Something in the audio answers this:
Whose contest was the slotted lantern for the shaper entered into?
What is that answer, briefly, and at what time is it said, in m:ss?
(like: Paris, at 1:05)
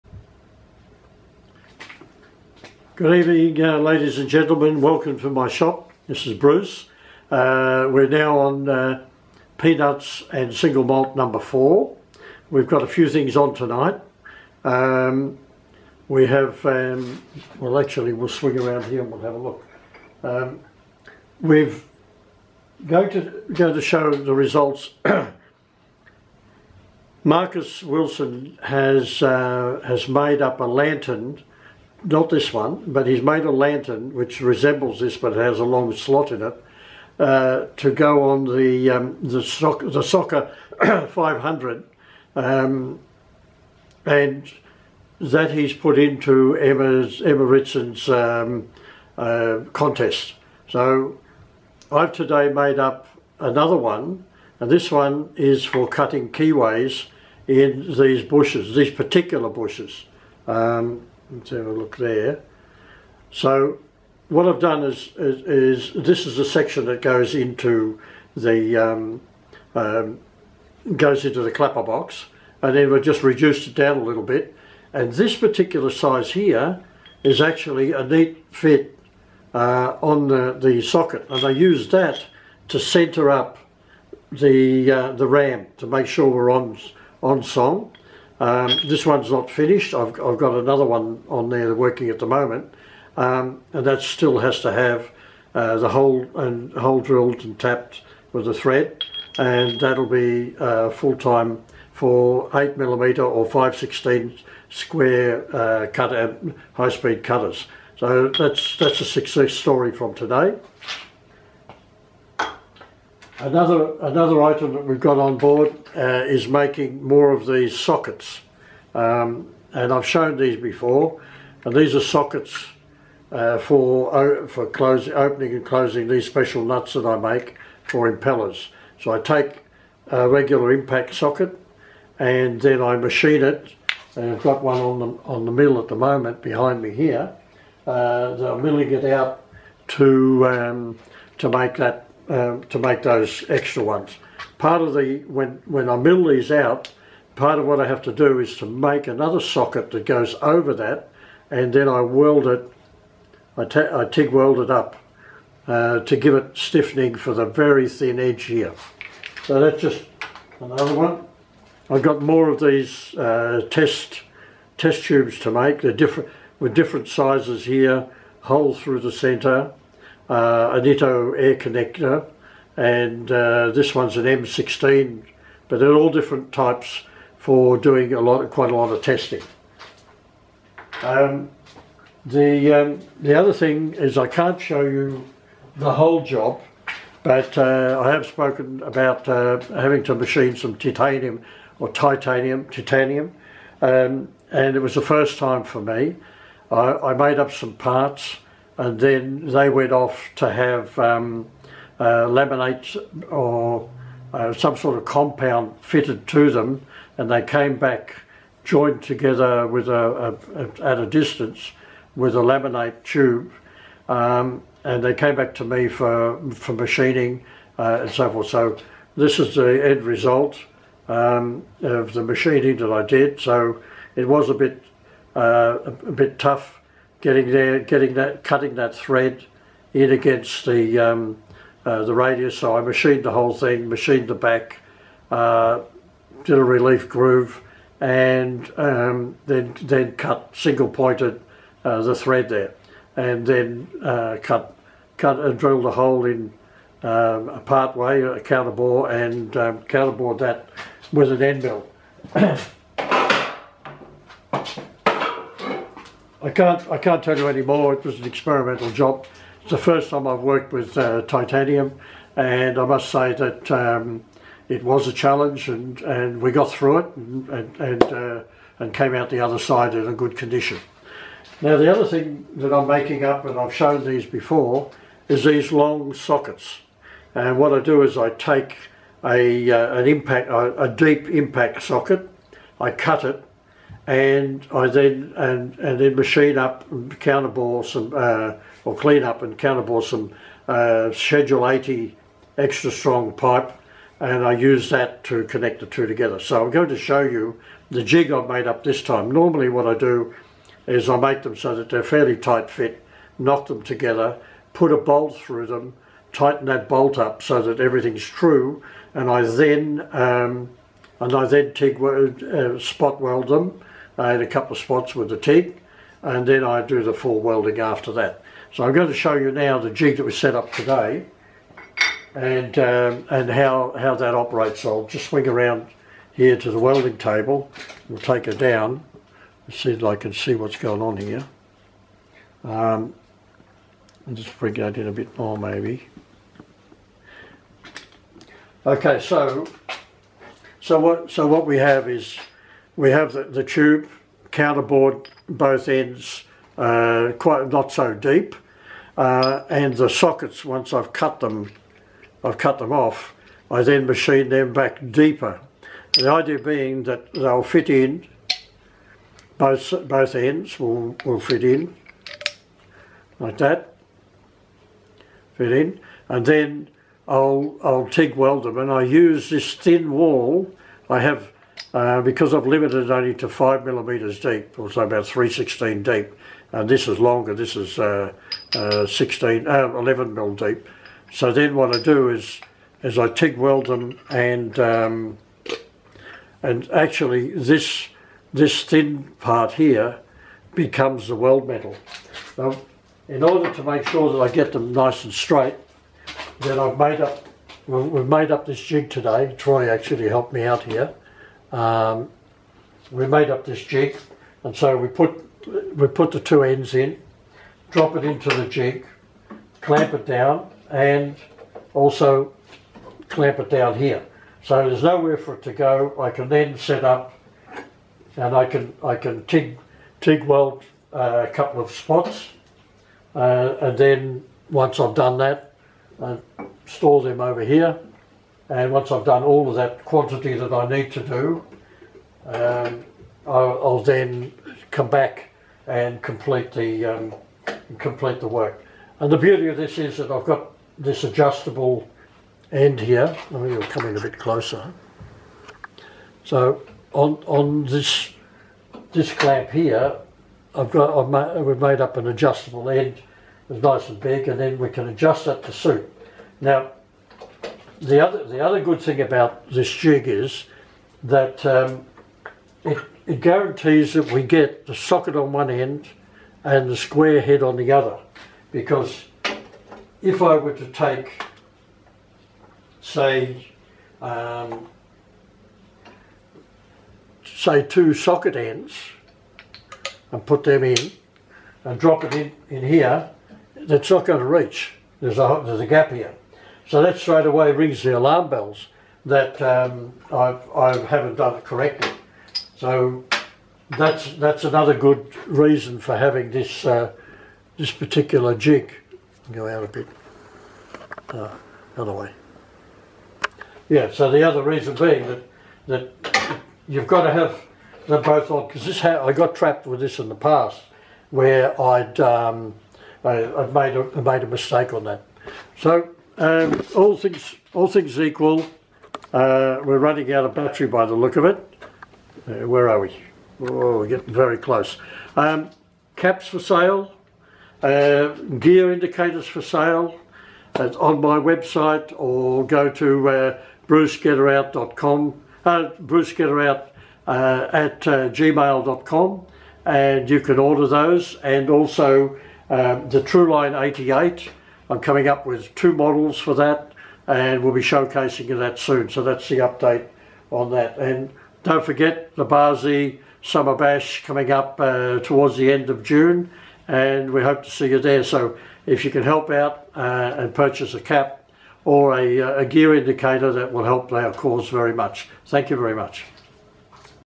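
Emma Ritson, at 0:47.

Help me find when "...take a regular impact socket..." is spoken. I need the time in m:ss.
2:09.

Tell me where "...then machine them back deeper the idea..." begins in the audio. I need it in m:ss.
5:53.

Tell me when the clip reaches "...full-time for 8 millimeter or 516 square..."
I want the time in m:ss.
1:40.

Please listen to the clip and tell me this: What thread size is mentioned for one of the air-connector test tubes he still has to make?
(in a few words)
M16.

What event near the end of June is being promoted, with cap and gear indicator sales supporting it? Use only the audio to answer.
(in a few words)
Bar Z Summer Bash.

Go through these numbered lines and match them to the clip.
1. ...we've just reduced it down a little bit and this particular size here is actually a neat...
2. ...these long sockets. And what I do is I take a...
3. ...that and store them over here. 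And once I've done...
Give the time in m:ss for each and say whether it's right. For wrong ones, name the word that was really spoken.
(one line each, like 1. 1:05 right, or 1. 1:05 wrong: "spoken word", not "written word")
1. 1:12 right
2. 4:35 right
3. 7:05 right.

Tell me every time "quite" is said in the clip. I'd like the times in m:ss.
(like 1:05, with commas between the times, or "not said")
2:58, 5:47.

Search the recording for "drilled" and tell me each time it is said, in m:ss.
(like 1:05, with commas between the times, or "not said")
1:37, 4:05.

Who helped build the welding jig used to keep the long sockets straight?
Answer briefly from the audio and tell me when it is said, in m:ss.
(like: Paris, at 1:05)
Troy, at 6:39.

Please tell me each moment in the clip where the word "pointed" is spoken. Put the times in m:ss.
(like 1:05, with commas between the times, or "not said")
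4:00.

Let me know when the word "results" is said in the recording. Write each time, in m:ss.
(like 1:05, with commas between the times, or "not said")
0:24, 3:40.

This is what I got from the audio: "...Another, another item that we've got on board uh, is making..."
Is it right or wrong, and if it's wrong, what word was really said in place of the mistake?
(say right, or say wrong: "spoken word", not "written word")
right.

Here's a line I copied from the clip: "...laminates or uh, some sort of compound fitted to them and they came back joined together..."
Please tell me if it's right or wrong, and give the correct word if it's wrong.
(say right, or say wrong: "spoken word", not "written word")
right.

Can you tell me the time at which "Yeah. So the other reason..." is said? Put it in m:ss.
8:23.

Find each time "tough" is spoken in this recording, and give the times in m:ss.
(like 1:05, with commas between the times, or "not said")
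3:46.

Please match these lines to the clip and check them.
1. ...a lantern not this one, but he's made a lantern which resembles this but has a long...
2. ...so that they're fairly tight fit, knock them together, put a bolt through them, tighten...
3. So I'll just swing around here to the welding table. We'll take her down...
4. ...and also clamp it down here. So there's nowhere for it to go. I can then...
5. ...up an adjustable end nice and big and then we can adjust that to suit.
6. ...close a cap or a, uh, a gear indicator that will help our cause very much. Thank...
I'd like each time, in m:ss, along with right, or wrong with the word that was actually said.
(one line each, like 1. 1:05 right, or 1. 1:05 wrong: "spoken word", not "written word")
1. 0:30 right
2. 5:01 right
3. 5:24 right
4. 6:50 right
5. 7:32 right
6. 9:20 wrong: "purchase", not "close".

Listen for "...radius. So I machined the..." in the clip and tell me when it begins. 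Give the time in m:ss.
3:52.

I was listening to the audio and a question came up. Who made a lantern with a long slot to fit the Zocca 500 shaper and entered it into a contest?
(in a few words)
Marcus Wilson.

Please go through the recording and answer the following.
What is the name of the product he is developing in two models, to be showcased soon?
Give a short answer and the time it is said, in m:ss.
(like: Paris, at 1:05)
True-Line 88, at 9:03.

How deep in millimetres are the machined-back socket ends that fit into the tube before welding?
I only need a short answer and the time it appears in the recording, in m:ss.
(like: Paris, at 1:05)
11, at 6:19.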